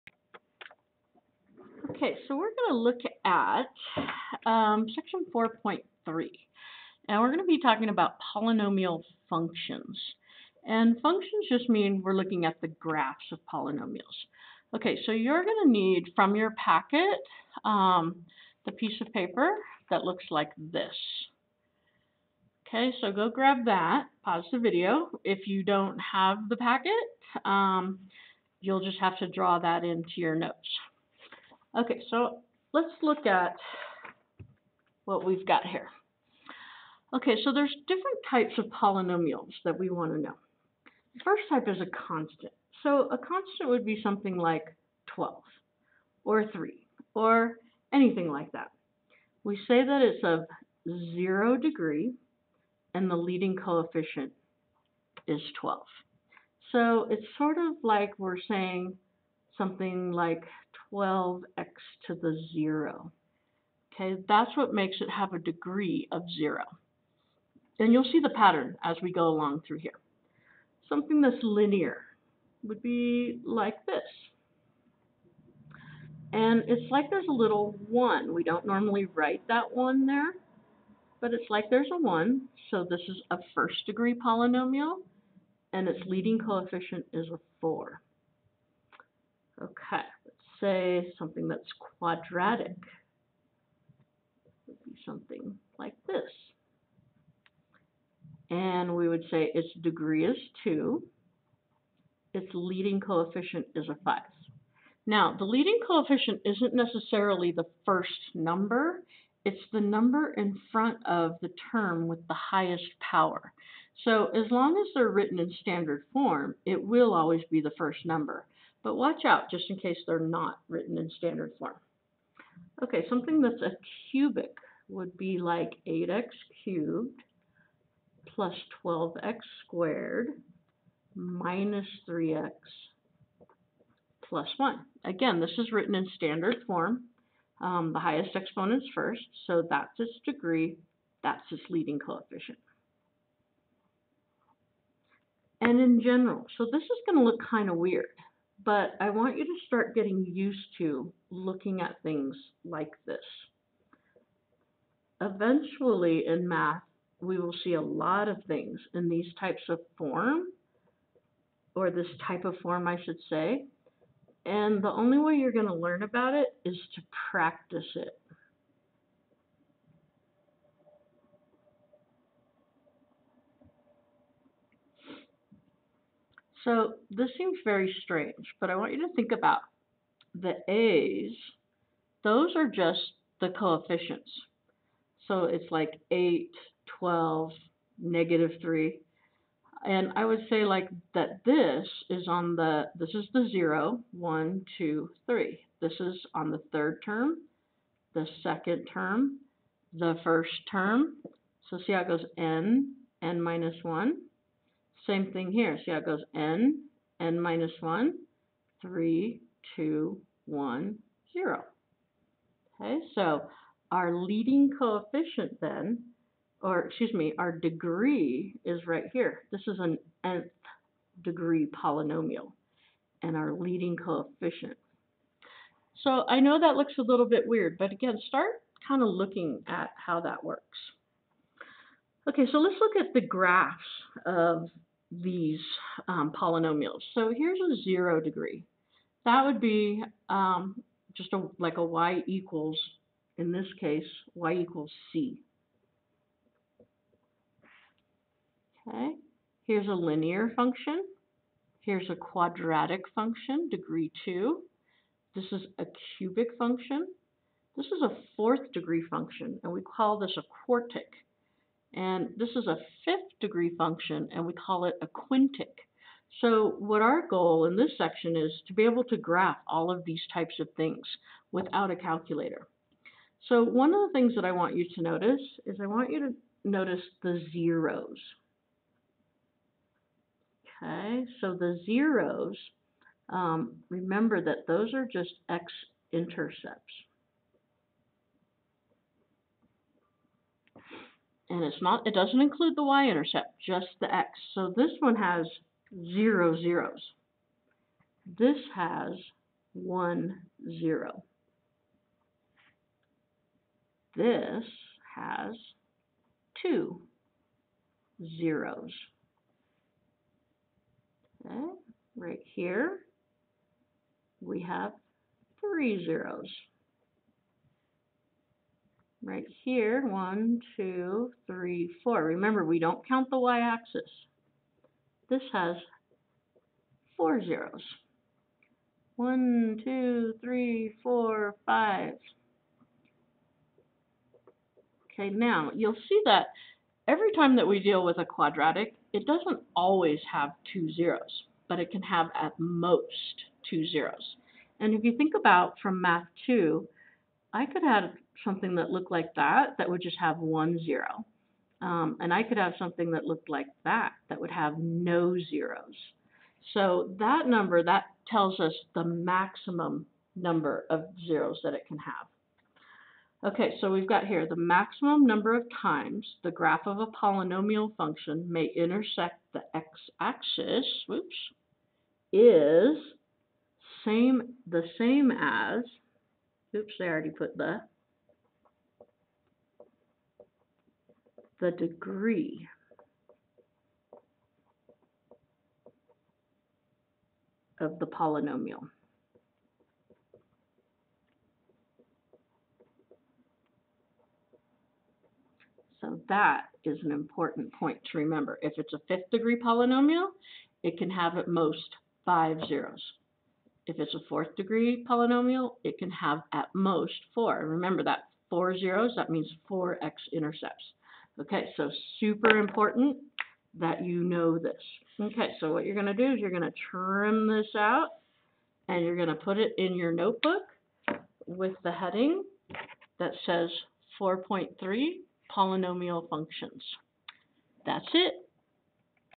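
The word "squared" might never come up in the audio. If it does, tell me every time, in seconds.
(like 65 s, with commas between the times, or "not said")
129 s.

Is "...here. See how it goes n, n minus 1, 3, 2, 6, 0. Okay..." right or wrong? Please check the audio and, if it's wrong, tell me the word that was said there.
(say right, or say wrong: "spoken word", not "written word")
wrong: "1", not "6".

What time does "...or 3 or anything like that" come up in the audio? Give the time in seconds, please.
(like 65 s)
46 s.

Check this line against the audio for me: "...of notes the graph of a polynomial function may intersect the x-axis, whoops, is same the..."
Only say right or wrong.
wrong.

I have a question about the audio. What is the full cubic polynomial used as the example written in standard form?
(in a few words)
8x^3 + 12x^2 - 3x + 1.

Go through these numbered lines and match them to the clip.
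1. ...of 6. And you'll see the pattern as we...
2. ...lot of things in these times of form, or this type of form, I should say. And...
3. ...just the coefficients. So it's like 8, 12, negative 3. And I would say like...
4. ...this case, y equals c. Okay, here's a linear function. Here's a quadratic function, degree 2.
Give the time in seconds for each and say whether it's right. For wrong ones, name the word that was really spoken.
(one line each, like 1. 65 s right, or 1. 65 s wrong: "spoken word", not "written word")
1. 66 s wrong: "0", not "6"
2. 157 s wrong: "types", not "times"
3. 182 s right
4. 243 s right.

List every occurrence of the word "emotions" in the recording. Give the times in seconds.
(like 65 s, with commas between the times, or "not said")
not said.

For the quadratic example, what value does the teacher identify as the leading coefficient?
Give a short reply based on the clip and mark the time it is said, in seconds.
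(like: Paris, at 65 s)
5, at 103 s.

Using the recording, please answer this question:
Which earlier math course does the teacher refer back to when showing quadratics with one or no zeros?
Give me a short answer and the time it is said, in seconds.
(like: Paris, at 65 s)
Math 2, at 346 s.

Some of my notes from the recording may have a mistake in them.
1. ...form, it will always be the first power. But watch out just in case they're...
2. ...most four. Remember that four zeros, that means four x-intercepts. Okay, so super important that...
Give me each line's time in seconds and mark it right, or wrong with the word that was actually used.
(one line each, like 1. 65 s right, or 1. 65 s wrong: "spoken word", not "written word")
1. 116 s wrong: "number", not "power"
2. 406 s right.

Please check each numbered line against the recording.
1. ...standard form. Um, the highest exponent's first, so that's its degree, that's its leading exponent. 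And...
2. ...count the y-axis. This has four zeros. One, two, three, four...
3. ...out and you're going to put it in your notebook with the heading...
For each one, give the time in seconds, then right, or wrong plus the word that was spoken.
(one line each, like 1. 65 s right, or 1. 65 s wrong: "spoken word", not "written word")
1. 136 s wrong: "coefficient", not "exponent"
2. 323 s right
3. 417 s right.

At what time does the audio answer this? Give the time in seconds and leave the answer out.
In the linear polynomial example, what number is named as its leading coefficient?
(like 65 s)
87 s.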